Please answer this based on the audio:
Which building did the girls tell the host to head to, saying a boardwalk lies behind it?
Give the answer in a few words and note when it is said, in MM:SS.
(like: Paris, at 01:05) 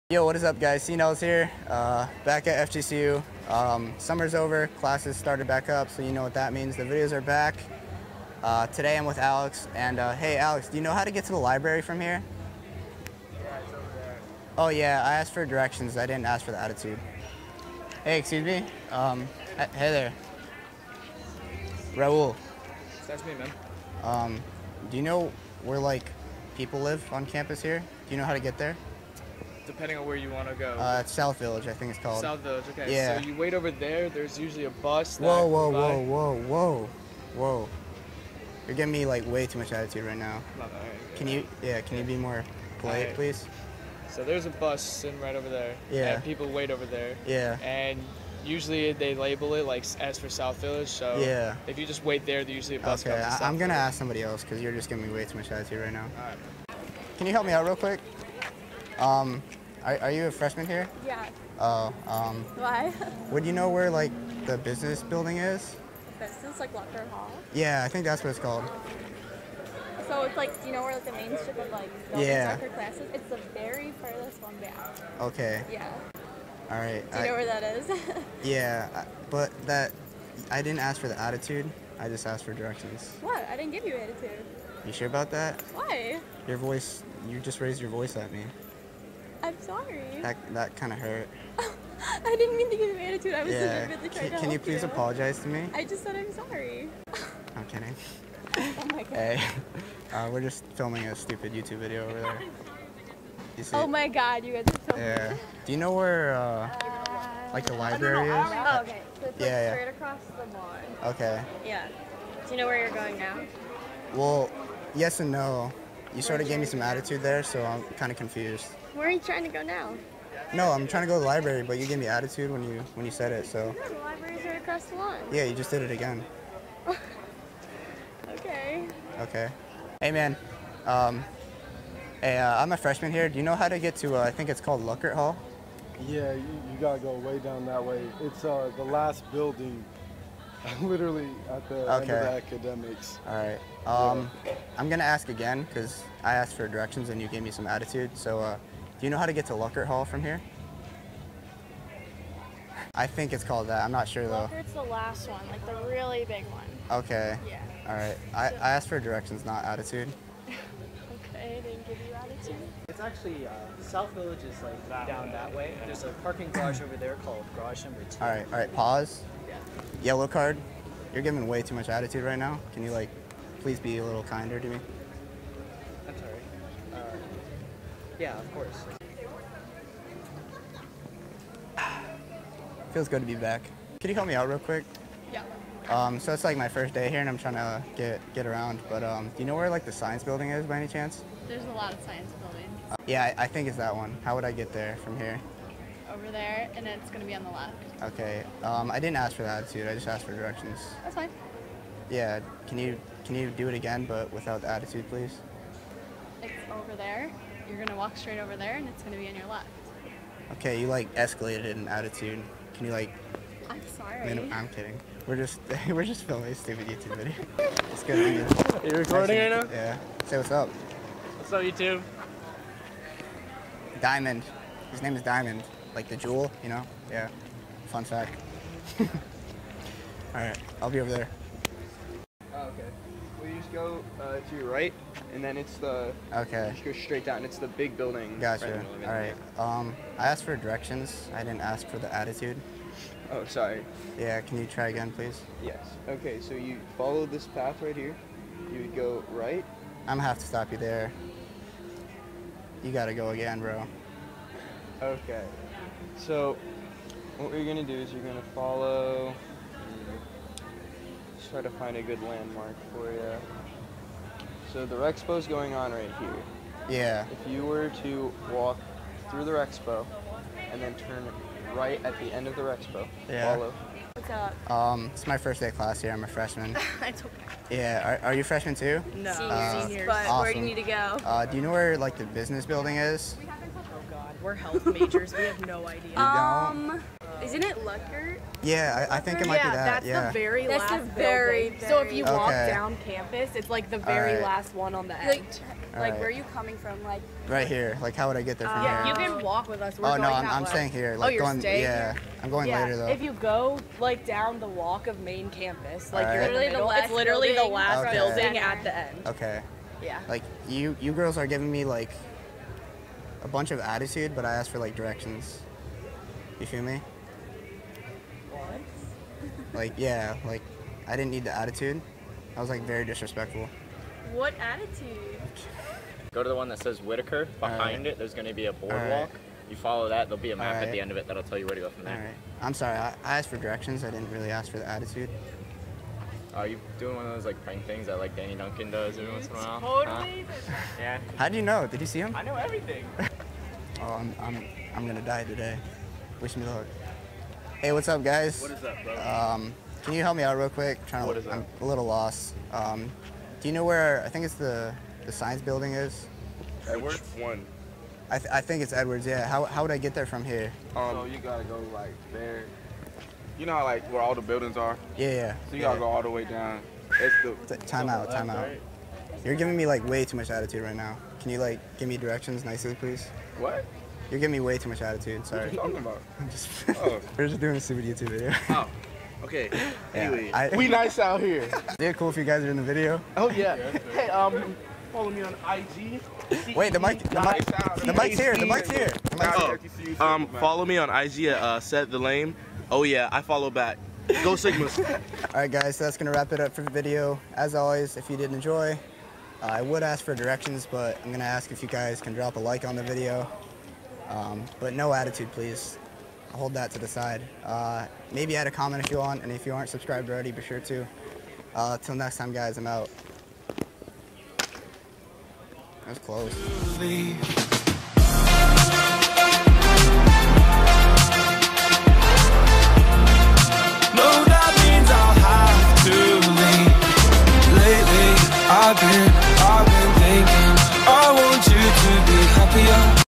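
Whitaker, at 05:27.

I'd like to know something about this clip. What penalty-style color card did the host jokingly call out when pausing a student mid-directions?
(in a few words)
Yellow card.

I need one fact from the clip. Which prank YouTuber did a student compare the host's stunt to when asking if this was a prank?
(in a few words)
Danny Duncan.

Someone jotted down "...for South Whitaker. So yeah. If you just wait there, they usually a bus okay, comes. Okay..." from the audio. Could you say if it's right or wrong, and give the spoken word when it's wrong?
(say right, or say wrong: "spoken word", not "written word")
wrong: "Village", not "Whitaker".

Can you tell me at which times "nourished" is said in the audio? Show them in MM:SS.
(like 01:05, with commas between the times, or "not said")
not said.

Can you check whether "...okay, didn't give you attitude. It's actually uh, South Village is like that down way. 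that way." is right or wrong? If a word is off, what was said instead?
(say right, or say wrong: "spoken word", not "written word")
right.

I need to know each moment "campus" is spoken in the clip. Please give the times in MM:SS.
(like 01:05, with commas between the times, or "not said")
00:27, 04:53, 05:05.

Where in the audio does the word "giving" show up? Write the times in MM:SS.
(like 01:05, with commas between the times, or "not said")
00:38, 00:54, 02:51, 05:11, 06:09, 06:14.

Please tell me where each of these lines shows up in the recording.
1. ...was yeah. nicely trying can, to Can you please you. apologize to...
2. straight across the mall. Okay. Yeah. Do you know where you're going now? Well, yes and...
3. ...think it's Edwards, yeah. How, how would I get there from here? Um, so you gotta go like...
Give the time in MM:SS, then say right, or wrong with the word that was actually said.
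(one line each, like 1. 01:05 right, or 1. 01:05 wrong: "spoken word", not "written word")
1. 01:33 wrong: "legitimately", not "nicely"
2. 01:49 right
3. 05:58 right.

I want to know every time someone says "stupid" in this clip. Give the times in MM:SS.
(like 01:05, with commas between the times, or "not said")
01:41, 03:36, 06:17.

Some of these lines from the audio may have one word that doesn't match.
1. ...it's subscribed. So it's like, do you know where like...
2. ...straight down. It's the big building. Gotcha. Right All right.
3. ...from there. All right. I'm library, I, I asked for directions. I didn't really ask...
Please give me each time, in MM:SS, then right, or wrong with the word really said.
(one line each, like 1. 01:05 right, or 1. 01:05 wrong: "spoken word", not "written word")
1. 01:08 wrong: "called", not "subscribed"
2. 03:56 right
3. 05:31 wrong: "sorry", not "library".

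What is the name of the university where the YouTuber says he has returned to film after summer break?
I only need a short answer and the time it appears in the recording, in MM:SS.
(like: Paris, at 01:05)
FGCU, at 00:02.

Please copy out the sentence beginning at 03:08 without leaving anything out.
But um, do you know where like the science building is by any chance?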